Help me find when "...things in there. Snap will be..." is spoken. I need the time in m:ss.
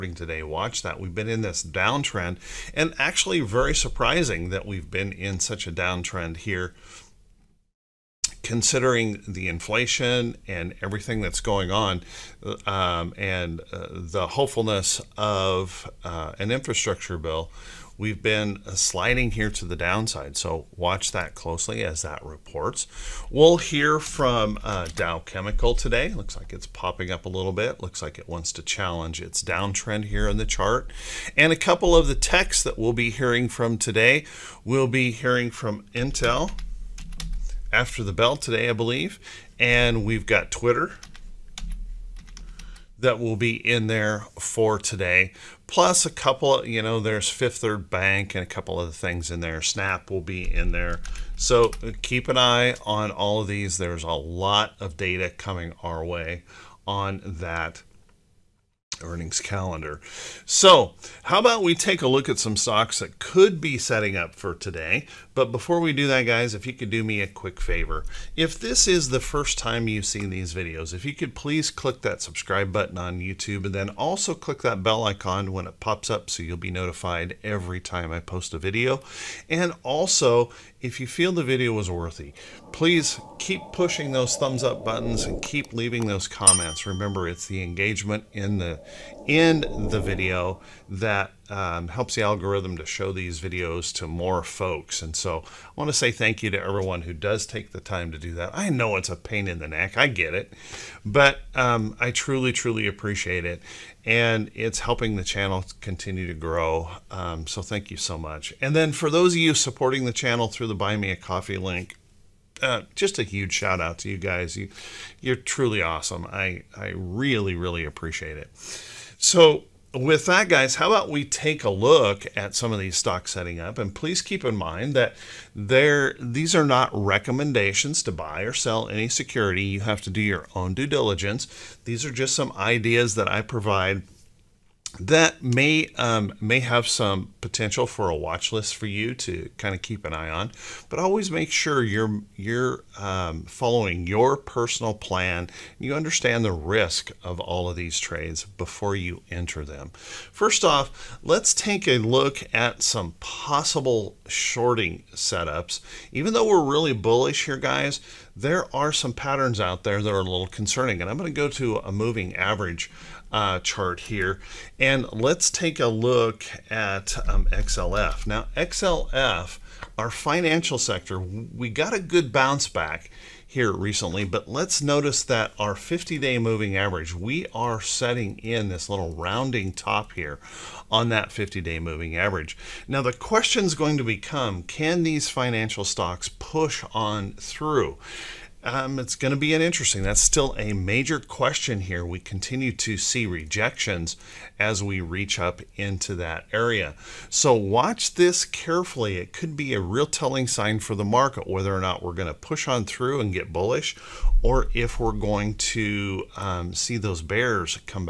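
0:48.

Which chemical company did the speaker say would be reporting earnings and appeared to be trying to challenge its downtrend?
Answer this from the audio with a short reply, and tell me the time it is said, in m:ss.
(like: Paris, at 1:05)
Dow Chemical, at 0:24.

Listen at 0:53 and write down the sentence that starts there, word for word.
There's a lot of data coming our way on that earnings calendar.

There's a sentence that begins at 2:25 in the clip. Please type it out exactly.
You understand the risk of all of these trades before you enter them.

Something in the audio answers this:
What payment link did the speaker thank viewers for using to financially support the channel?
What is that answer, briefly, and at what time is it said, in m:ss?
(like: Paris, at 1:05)
Buy Me a Coffee, at 1:50.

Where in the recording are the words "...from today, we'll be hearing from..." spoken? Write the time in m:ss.
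0:33.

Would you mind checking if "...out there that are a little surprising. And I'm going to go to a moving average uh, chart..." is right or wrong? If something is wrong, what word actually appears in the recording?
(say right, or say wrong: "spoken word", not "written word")
wrong: "concerning", not "surprising".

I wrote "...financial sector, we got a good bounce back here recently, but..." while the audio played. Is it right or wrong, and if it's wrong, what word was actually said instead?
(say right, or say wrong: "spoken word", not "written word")
right.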